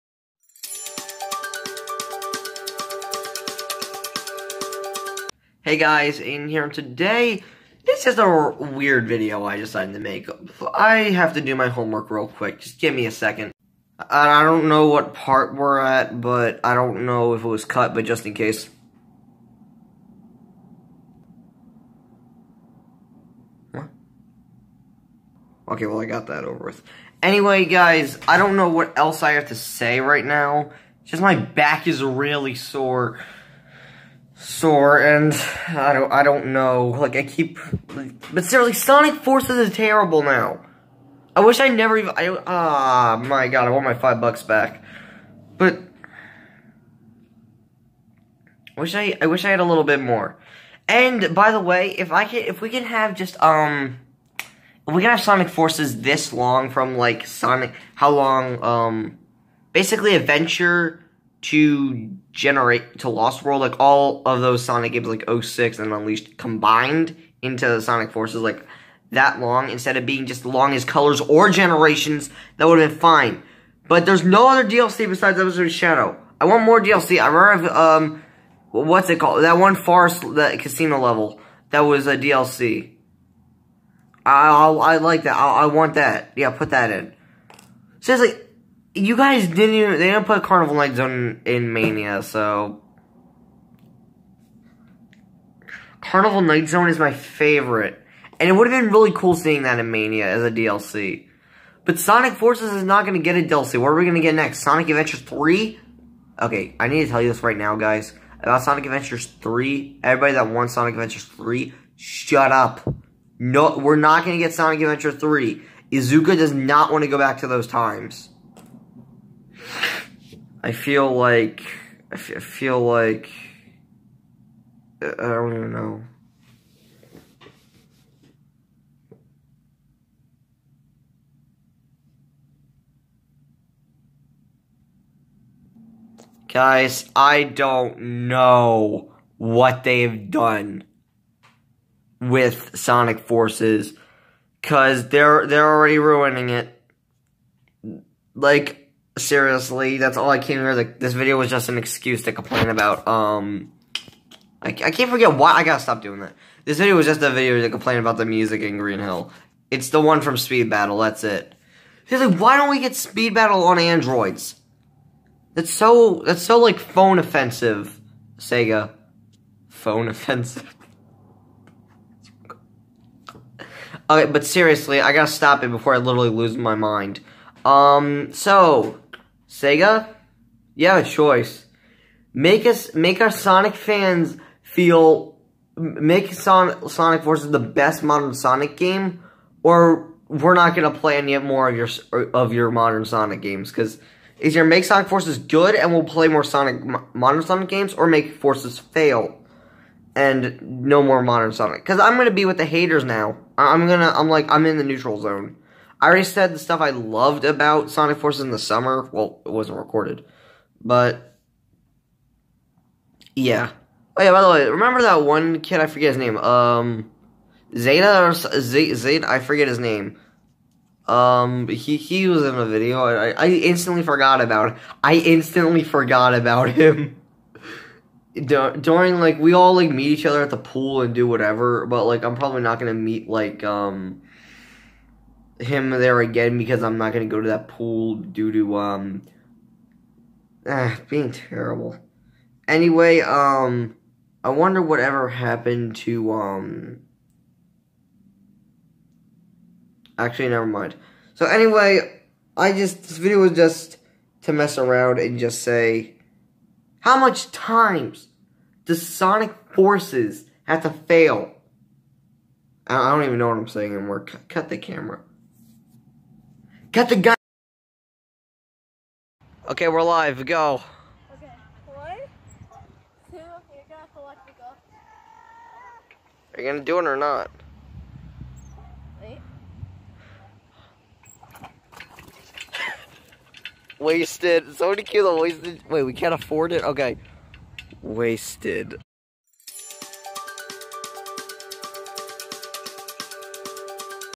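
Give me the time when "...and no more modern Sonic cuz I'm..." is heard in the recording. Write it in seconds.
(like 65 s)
200 s.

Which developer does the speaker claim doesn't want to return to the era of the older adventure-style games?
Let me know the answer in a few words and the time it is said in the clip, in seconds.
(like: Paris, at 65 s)
Iizuka, at 115 s.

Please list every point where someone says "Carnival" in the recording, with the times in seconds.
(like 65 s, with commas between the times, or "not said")
90 s, 96 s.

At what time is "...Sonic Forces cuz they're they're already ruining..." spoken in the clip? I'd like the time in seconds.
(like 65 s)
142 s.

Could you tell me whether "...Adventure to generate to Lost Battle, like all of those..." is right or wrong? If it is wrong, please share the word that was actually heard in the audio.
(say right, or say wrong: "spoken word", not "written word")
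wrong: "World", not "Battle".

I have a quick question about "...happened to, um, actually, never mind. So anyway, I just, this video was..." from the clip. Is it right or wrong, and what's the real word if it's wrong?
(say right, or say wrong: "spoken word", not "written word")
right.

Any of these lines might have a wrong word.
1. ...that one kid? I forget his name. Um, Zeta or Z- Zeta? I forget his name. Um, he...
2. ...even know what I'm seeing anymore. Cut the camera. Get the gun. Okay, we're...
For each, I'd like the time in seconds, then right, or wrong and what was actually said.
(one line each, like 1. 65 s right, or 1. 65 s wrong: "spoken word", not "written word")
1. 215 s right
2. 263 s wrong: "saying", not "seeing".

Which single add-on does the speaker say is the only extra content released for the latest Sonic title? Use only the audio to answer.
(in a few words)
Episode Shadow.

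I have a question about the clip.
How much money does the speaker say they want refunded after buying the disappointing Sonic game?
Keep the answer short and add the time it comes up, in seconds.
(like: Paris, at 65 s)
$5, at 43 s.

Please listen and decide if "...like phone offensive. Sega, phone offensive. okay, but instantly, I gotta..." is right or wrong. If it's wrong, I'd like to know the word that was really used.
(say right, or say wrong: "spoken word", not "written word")
wrong: "seriously", not "instantly".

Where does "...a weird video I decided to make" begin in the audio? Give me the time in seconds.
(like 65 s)
8 s.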